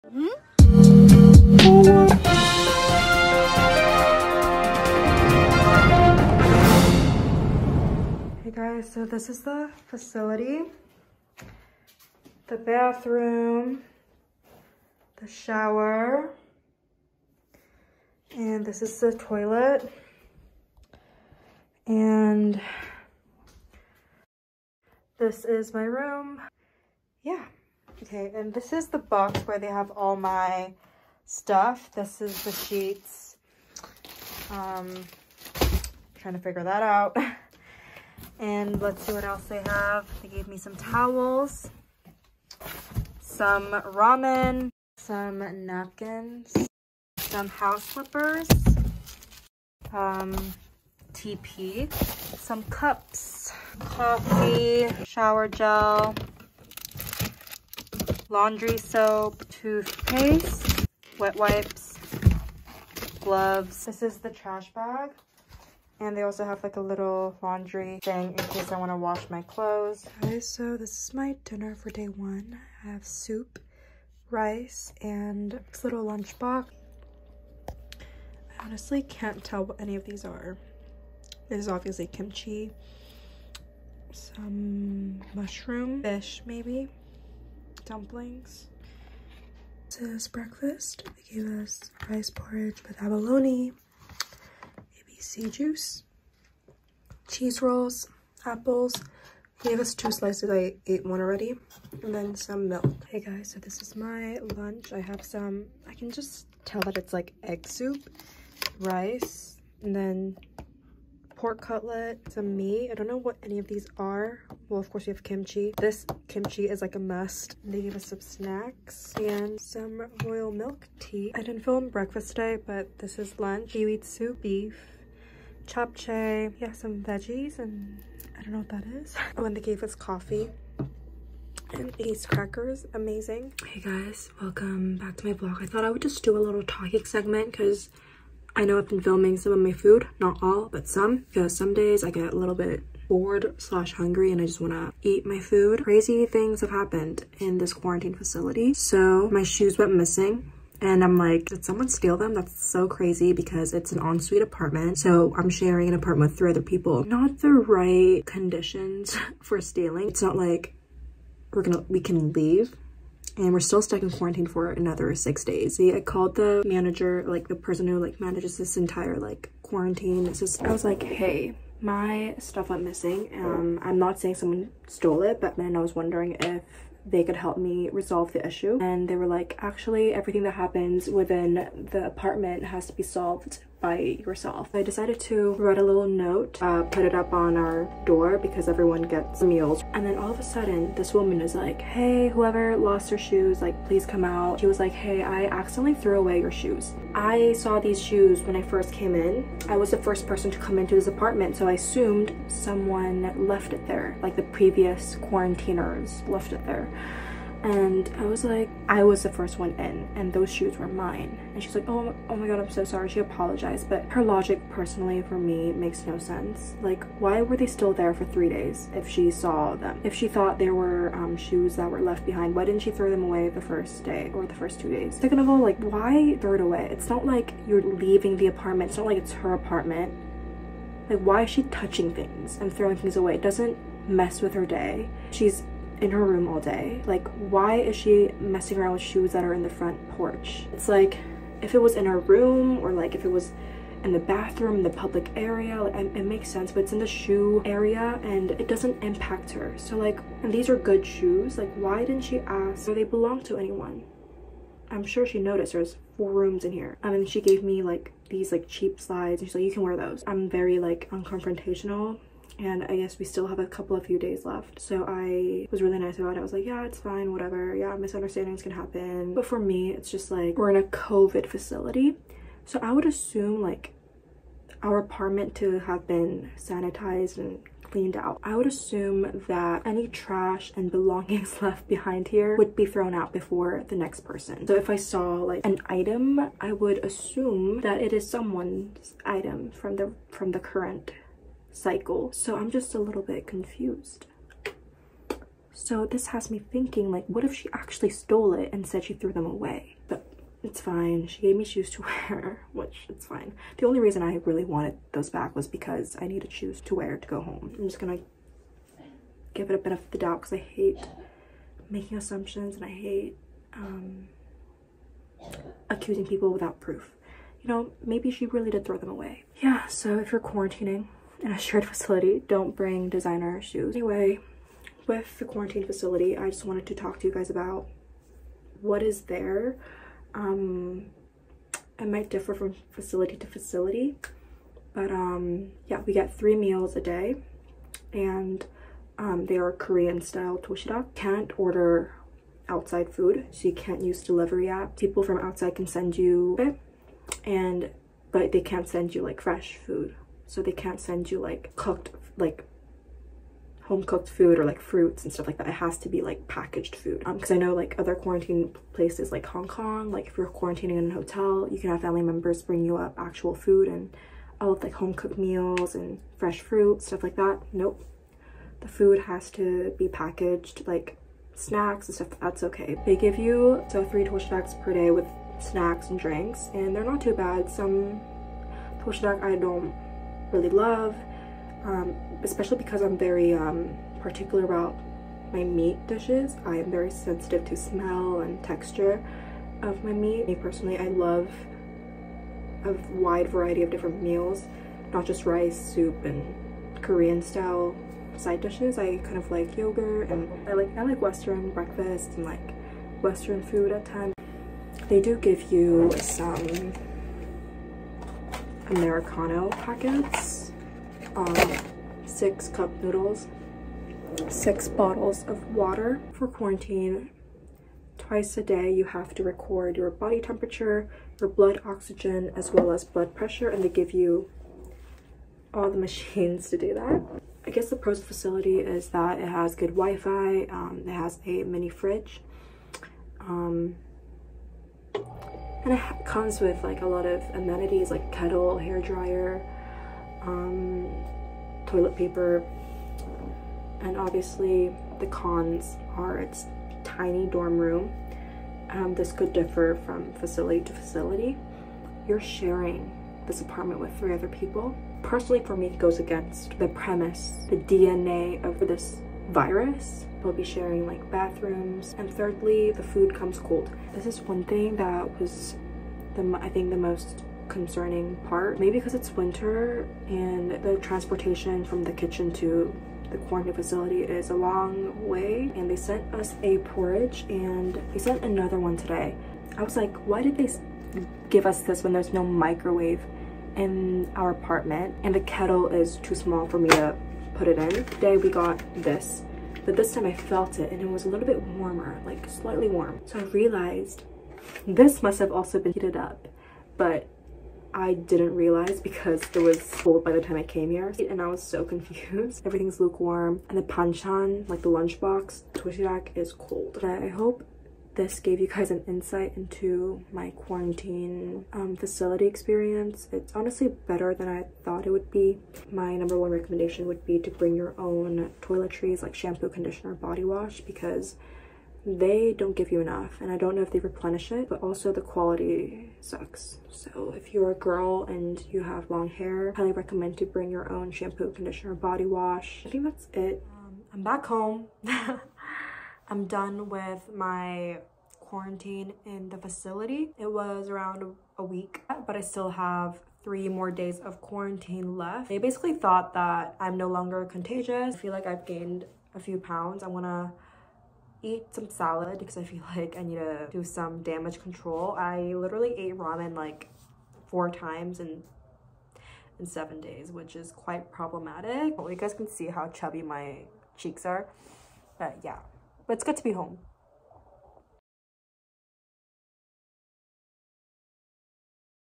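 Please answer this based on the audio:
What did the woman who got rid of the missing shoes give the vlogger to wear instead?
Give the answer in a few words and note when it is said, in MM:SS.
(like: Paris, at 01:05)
Cheap slides, at 04:18.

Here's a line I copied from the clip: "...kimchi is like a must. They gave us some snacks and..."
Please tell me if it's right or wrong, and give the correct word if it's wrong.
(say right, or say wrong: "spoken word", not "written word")
right.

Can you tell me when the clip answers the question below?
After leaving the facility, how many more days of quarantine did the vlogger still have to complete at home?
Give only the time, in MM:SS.
09:03.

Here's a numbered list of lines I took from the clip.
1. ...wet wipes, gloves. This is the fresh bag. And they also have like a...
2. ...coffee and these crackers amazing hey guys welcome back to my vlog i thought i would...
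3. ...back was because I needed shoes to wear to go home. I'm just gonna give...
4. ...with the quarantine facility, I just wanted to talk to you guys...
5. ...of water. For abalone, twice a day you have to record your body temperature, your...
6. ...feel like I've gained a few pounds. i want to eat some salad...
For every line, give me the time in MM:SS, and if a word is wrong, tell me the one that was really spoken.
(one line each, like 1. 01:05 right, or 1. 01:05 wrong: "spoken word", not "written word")
1. 01:01 wrong: "trash", not "fresh"
2. 02:09 right
3. 05:05 right
4. 05:25 right
5. 06:55 wrong: "quarantine", not "abalone"
6. 09:08 right.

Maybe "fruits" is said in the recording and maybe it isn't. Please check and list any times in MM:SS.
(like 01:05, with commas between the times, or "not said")
05:54, 06:06.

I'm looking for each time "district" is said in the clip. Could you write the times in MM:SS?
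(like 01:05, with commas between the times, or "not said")
not said.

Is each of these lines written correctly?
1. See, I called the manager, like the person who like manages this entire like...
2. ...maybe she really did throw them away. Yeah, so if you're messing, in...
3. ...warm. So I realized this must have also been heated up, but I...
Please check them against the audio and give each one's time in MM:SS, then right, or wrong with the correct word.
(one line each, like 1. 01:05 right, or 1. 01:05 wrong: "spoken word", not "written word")
1. 02:45 right
2. 05:18 wrong: "quarantining", not "messing"
3. 08:12 right.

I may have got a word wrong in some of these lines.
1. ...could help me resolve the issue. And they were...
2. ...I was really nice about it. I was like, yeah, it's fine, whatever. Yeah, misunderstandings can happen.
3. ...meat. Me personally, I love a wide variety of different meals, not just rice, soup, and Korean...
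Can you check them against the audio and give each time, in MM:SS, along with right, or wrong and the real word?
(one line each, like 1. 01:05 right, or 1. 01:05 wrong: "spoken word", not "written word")
1. 02:57 right
2. 04:25 right
3. 06:30 right.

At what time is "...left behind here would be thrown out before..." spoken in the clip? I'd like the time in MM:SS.
04:41.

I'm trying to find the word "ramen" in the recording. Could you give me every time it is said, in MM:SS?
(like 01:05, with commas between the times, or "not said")
00:43, 09:16.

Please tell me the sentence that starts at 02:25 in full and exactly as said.
Crazy things have happened in this quarantine facility.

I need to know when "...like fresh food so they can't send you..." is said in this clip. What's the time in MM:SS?
05:49.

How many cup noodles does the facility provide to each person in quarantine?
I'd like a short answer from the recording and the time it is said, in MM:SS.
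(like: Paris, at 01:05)
6, at 06:52.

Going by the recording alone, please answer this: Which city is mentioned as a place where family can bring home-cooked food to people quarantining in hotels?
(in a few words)
Hong Kong.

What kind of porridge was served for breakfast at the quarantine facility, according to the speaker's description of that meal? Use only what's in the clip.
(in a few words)
Abalone.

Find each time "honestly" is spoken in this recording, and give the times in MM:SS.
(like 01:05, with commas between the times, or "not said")
01:18, 08:33.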